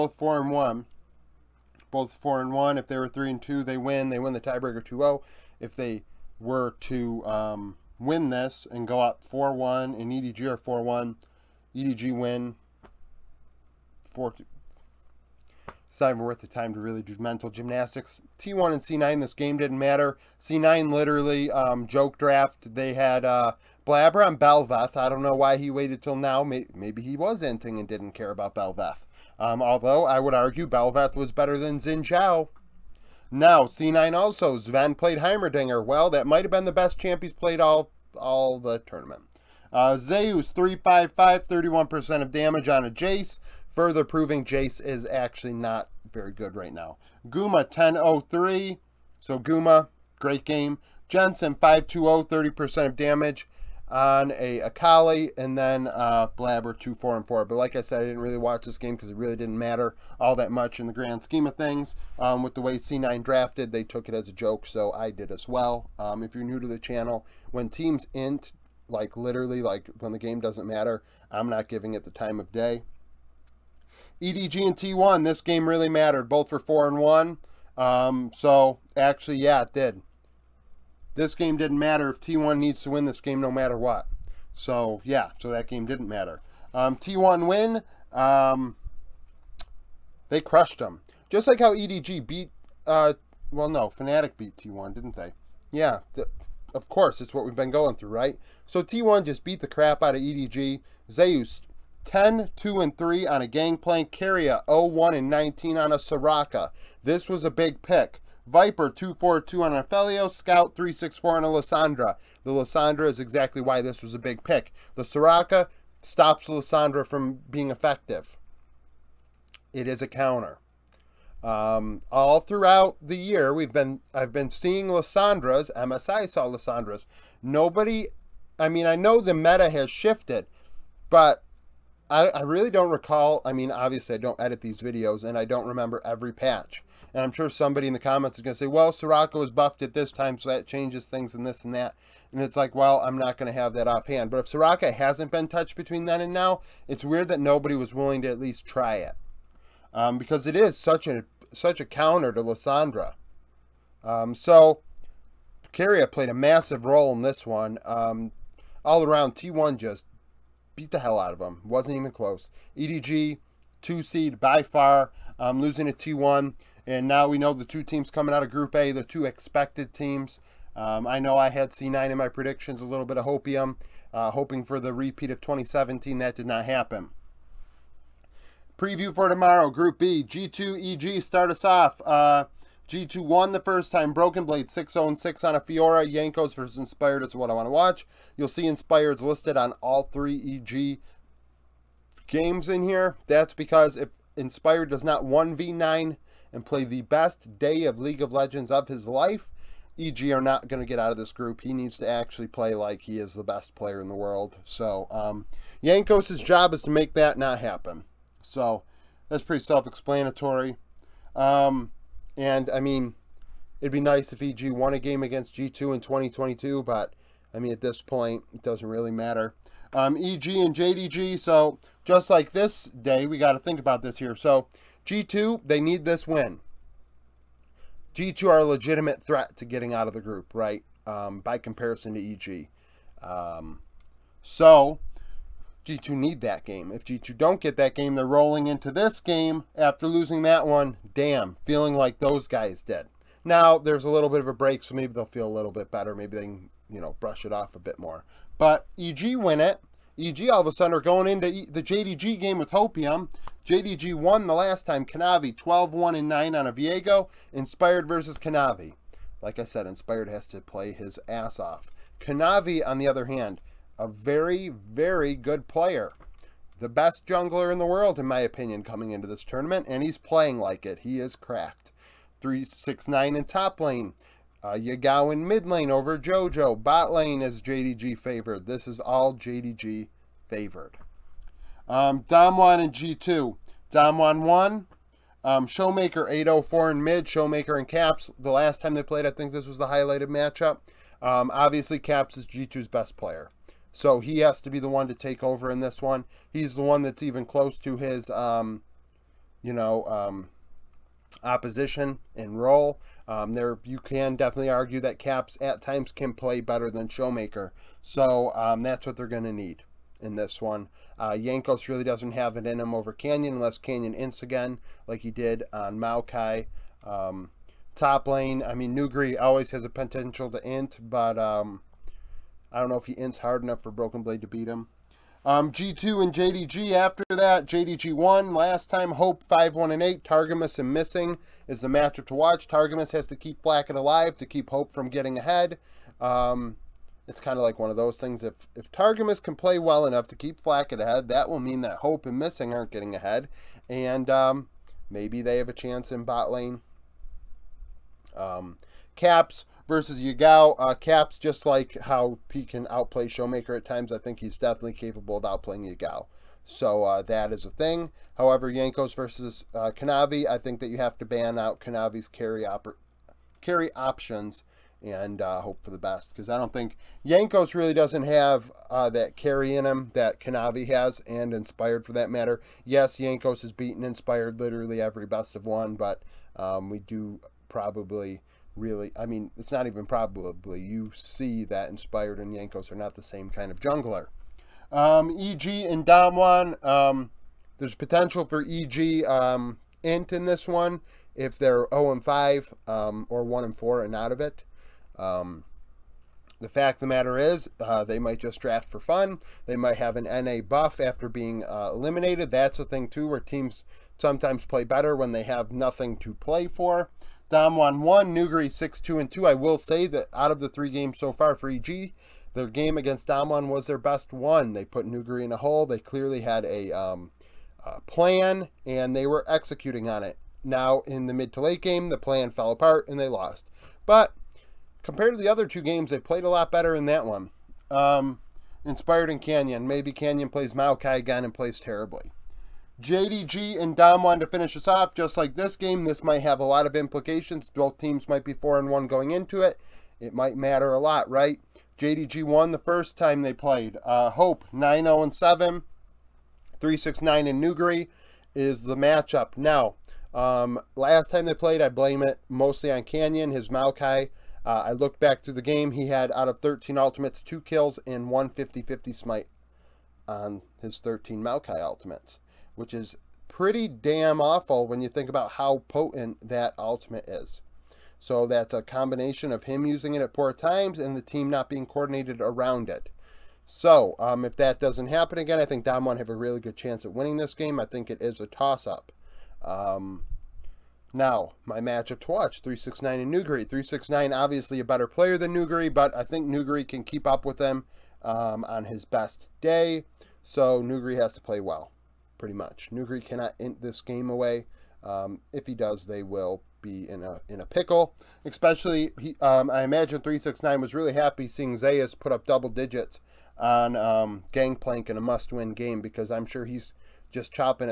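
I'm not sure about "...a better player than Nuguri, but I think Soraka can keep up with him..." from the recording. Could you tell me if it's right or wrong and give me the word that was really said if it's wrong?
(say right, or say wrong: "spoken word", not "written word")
wrong: "Nuguri", not "Soraka".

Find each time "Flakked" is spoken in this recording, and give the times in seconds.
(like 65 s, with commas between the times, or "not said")
333 s, 340 s.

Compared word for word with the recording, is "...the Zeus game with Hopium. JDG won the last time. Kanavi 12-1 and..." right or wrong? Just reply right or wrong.
wrong.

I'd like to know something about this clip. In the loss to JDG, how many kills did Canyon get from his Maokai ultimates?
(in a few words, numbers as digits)
2.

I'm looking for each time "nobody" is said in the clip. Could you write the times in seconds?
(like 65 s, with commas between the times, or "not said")
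127 s, 147 s.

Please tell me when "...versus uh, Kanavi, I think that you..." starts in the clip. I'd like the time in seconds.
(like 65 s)
359 s.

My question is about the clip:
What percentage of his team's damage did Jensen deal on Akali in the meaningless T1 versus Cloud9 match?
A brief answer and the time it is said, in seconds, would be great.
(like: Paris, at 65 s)
30%, at 52 s.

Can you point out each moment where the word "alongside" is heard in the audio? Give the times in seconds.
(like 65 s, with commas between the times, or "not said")
not said.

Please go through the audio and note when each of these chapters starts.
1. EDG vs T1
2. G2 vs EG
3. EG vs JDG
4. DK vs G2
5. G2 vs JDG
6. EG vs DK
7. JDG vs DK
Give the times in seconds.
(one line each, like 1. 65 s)
1. 73 s
2. 178 s
3. 219 s
4. 281 s
5. 324 s
6. 385 s
7. 432 s.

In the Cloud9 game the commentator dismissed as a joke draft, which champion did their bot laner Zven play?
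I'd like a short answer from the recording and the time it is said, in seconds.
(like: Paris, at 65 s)
Heimerdinger, at 35 s.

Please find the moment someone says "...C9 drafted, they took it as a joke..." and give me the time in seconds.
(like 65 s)
62 s.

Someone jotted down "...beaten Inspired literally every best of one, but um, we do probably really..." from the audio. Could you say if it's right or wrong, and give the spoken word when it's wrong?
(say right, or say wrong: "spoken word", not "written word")
right.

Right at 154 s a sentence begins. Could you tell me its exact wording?
Um, so, Keria played a massive role in this one.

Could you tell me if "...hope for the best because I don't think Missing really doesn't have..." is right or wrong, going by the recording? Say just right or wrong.
wrong.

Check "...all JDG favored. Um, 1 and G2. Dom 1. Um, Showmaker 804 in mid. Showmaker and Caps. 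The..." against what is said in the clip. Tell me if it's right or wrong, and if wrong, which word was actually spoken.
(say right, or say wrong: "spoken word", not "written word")
right.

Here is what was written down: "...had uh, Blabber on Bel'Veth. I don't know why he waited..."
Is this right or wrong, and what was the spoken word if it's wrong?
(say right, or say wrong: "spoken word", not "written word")
right.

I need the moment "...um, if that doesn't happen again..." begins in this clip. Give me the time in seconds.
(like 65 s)
474 s.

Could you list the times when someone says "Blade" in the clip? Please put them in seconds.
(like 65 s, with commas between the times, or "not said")
184 s, 324 s.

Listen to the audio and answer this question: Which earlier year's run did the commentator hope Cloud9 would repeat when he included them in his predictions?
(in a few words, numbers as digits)
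2017.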